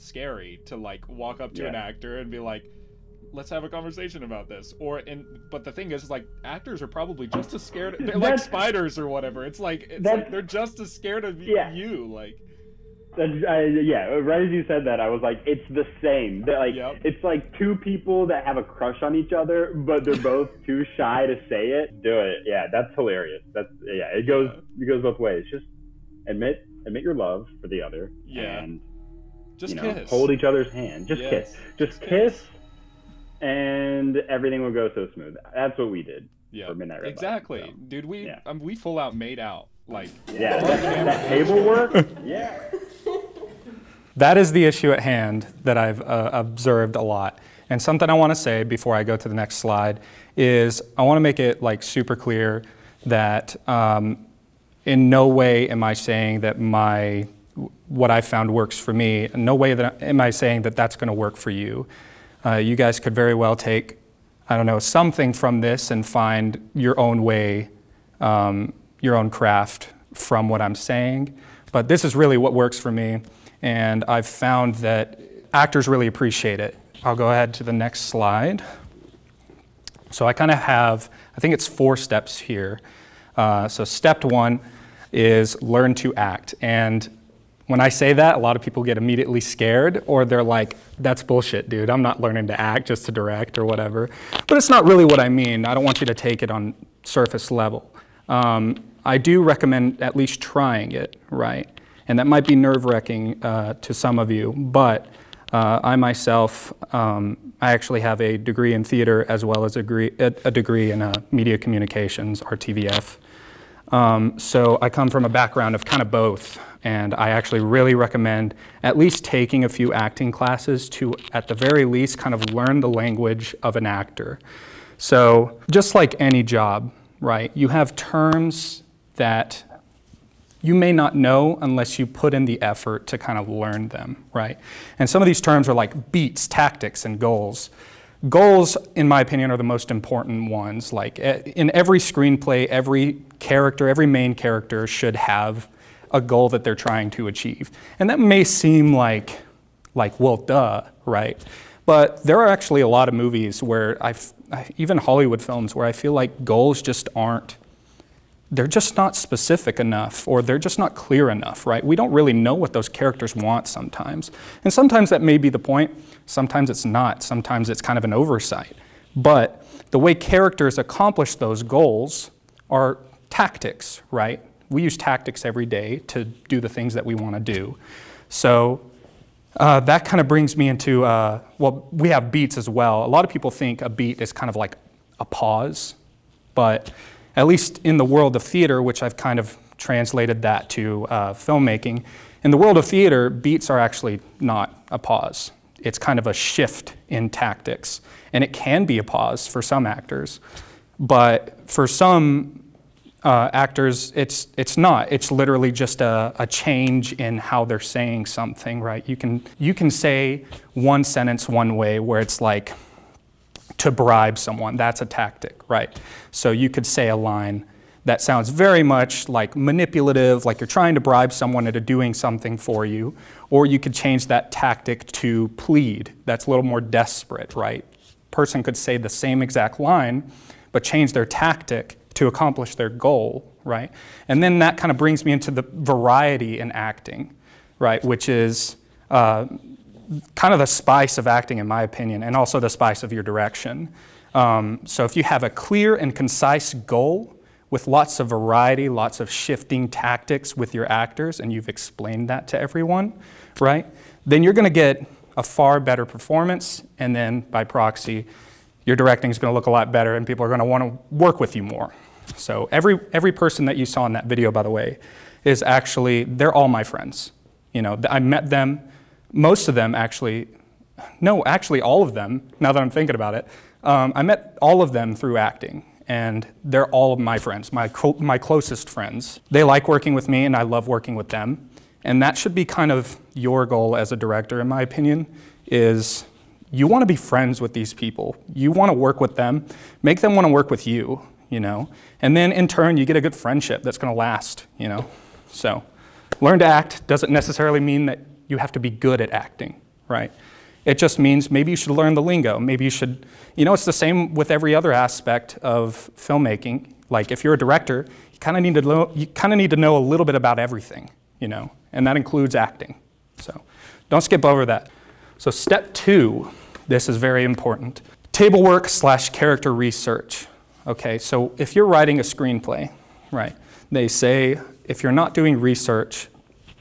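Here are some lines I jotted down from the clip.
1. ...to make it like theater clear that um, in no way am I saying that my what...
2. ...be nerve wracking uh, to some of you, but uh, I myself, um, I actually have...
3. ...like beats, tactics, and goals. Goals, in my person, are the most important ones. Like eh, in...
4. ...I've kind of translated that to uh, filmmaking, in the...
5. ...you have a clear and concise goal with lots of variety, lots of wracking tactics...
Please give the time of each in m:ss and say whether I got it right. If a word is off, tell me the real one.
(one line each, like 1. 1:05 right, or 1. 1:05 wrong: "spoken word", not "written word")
1. 0:51 wrong: "super", not "theater"
2. 1:42 right
3. 2:15 wrong: "opinion", not "person"
4. 3:09 right
5. 4:05 wrong: "shifting", not "wracking".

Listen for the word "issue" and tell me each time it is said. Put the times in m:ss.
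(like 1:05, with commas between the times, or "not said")
0:44.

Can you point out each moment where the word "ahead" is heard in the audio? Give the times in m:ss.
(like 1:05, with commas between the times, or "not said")
1:17.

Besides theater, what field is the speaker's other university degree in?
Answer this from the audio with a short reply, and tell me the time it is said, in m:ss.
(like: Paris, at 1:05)
Media communications, at 1:51.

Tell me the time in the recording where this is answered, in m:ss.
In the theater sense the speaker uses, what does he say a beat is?
3:16.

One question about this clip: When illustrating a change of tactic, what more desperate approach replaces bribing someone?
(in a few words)
Plead.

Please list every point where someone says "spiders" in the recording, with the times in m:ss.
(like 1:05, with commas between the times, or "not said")
0:08.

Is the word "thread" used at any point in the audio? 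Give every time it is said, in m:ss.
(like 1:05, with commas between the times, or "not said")
not said.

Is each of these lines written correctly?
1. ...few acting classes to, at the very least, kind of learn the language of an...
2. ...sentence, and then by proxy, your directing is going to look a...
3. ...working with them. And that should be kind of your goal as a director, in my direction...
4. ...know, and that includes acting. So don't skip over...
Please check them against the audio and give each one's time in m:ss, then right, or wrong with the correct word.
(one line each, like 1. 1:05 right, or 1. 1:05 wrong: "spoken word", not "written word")
1. 1:59 right
2. 4:16 wrong: "performance", not "sentence"
3. 4:40 wrong: "opinion", not "direction"
4. 5:11 right.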